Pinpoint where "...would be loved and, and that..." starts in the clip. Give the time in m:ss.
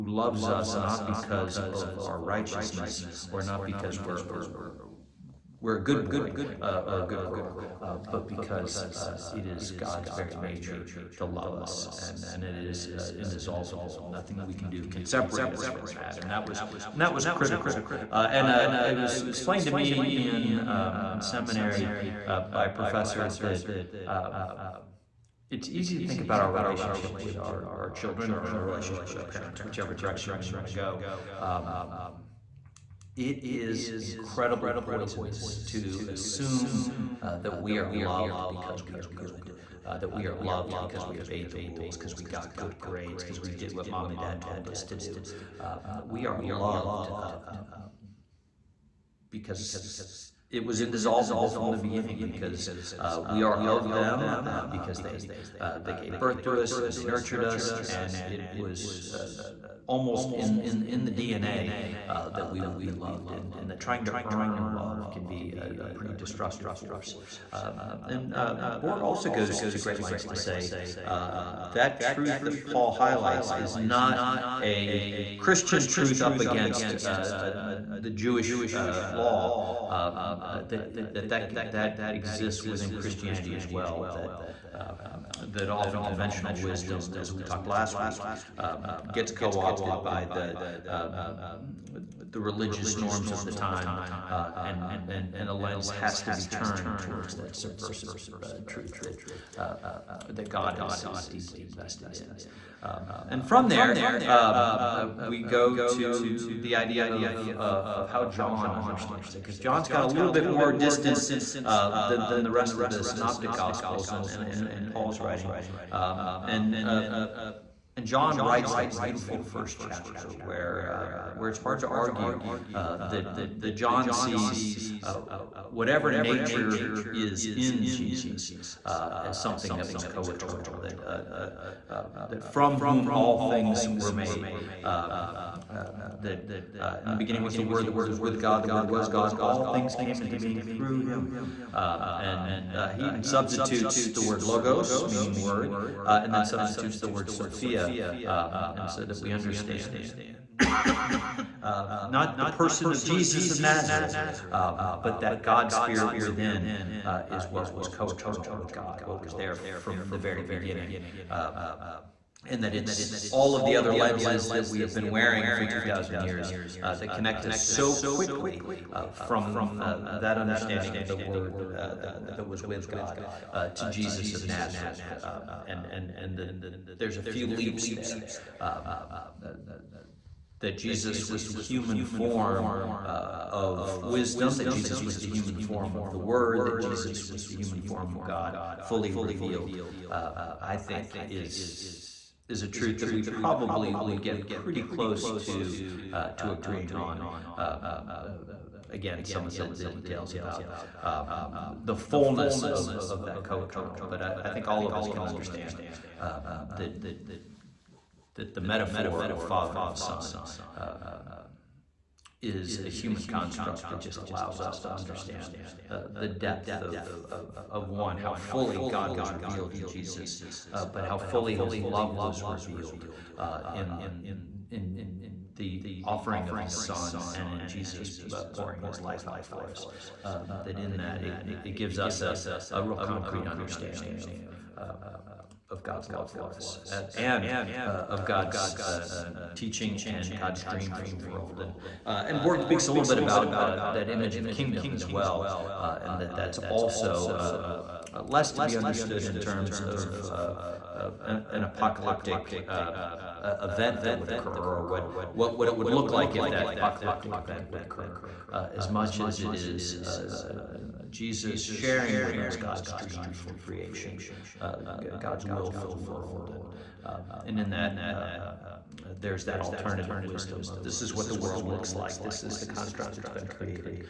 1:02.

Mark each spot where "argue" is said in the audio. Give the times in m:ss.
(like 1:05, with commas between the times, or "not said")
2:01.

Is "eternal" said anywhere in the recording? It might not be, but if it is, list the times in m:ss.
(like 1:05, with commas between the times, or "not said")
2:10, 2:37, 3:23.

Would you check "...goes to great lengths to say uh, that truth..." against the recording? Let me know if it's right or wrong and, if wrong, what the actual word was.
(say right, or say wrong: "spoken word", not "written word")
right.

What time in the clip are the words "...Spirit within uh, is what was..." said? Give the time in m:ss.
2:35.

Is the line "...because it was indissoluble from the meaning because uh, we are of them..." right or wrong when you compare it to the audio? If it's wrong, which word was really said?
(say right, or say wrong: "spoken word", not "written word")
wrong: "beginning", not "meaning".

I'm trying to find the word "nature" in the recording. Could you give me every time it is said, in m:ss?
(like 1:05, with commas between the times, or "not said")
0:10, 2:06.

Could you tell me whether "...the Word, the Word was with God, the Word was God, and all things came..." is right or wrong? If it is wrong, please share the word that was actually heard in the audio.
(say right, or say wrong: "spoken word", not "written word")
right.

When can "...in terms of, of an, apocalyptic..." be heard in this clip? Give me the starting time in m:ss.
4:09.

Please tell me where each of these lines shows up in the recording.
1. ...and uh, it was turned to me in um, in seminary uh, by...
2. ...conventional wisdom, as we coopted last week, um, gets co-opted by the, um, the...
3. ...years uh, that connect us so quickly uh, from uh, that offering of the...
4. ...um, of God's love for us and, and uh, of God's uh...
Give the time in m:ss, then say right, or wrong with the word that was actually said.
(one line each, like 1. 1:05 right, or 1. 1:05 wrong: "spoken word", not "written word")
1. 0:18 wrong: "explained", not "turned"
2. 1:26 wrong: "talked", not "coopted"
3. 2:46 wrong: "understanding", not "offering"
4. 3:54 right.